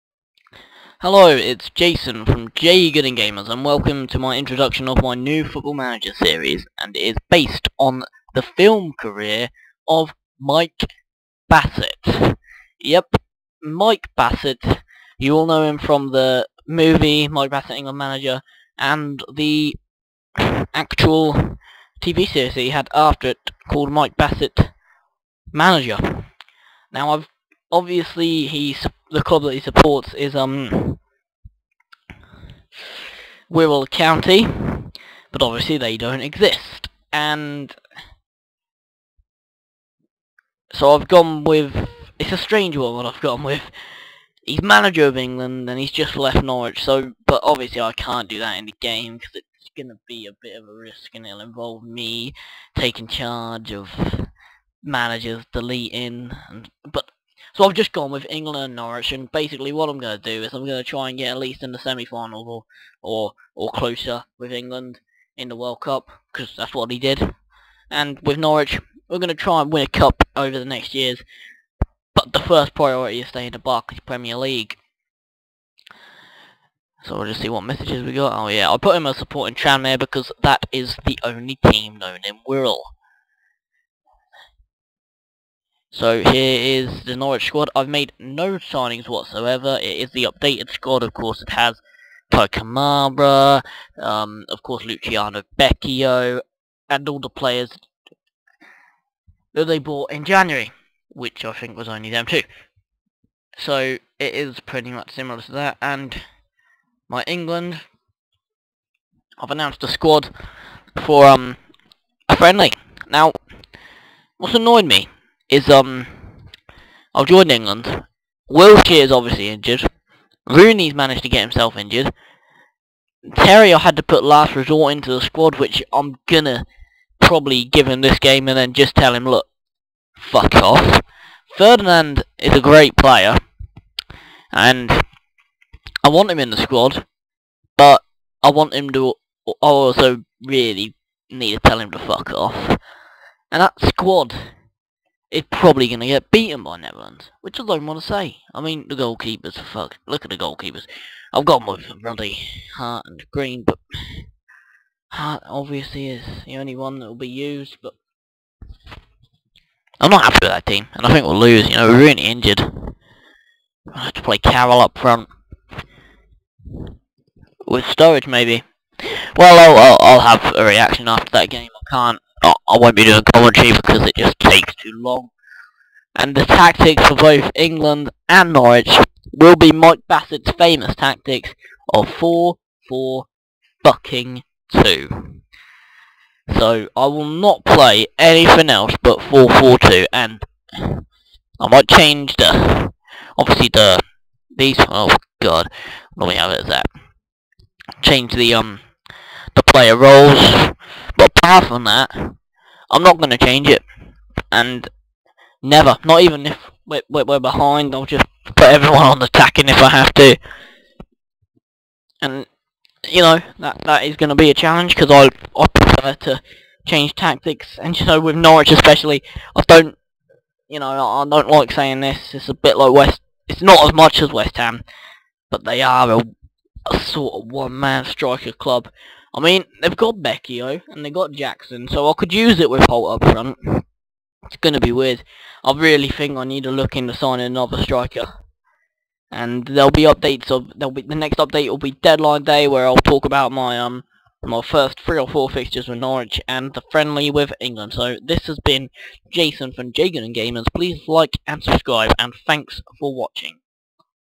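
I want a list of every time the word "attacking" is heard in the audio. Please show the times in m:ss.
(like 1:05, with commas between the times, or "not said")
3:29.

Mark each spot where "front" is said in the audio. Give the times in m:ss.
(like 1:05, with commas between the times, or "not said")
2:44, 3:53.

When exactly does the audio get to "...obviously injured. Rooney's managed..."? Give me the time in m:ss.
1:59.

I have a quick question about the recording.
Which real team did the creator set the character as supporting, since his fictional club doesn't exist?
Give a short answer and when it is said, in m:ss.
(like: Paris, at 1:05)
Tranmere, at 1:19.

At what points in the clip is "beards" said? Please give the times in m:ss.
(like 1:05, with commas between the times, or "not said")
not said.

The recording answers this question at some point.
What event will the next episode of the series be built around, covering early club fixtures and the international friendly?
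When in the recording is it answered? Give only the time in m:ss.
4:01.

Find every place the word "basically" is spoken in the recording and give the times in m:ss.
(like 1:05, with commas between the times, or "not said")
0:59.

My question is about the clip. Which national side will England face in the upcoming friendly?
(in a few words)
Netherlands.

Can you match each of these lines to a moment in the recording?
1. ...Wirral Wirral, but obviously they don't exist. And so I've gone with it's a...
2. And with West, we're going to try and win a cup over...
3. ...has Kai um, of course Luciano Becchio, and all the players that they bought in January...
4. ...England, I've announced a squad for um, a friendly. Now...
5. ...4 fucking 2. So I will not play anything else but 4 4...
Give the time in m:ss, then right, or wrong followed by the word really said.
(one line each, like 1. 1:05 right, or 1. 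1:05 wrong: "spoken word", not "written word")
1. 0:33 wrong: "County", not "Wirral"
2. 1:07 wrong: "Norwich", not "West"
3. 1:31 right
4. 1:47 right
5. 3:02 right.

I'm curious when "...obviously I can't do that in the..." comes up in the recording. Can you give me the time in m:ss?
0:47.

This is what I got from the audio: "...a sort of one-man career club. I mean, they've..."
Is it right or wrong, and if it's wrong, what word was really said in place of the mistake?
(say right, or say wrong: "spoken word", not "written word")
wrong: "striker", not "career".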